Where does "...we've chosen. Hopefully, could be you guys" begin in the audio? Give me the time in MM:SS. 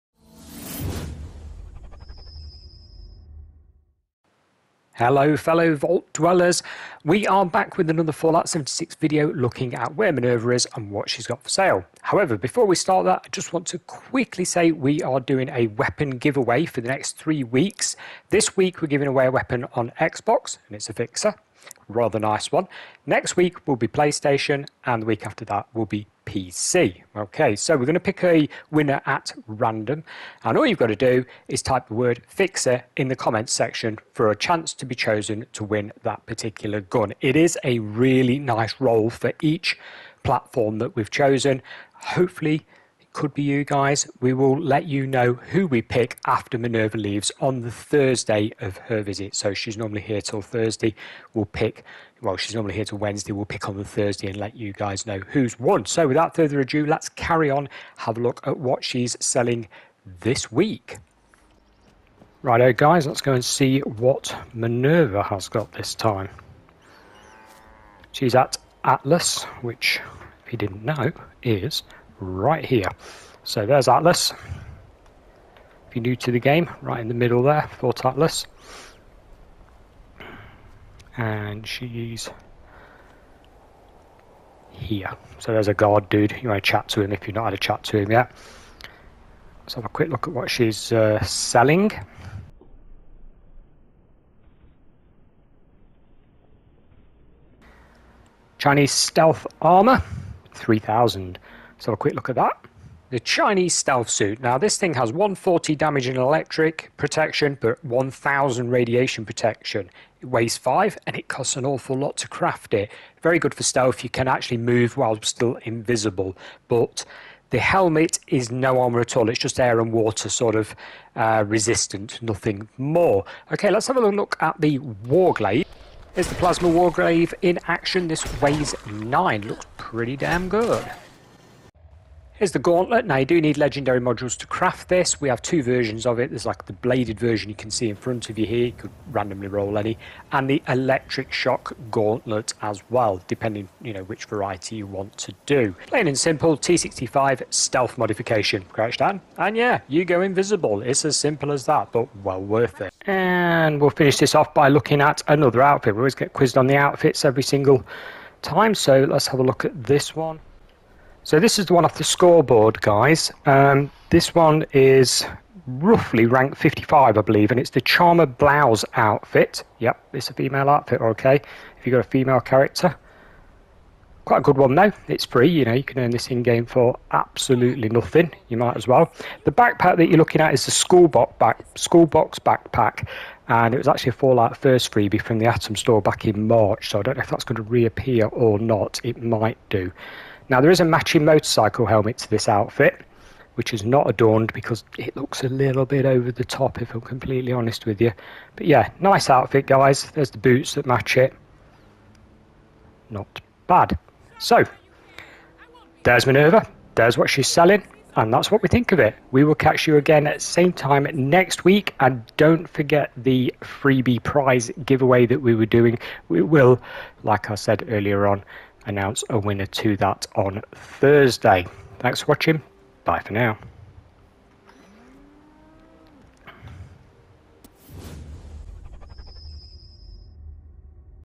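00:40.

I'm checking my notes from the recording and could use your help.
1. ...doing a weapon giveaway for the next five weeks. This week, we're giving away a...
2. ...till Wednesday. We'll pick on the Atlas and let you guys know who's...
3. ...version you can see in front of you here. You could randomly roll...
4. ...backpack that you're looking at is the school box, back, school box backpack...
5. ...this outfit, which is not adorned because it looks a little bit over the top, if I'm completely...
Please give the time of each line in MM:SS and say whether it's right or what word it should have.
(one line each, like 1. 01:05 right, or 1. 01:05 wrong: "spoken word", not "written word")
1. 00:15 wrong: "three", not "five"
2. 00:52 wrong: "Thursday", not "Atlas"
3. 02:17 right
4. 02:59 right
5. 03:12 right.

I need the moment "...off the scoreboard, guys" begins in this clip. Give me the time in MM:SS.
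02:41.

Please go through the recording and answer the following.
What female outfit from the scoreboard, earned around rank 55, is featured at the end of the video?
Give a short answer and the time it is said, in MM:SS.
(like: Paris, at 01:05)
Charmer Blouse, at 02:47.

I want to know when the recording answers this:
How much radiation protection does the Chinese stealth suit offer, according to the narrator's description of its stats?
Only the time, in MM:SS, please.
01:47.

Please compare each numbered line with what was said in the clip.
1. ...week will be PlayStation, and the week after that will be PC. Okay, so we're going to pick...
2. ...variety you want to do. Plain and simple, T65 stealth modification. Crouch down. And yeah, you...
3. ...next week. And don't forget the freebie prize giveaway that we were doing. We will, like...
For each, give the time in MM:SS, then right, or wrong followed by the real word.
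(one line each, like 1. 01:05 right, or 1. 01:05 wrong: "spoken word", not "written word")
1. 00:23 right
2. 02:24 right
3. 03:31 right.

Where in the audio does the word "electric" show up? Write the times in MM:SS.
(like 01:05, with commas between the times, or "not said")
01:46, 02:20.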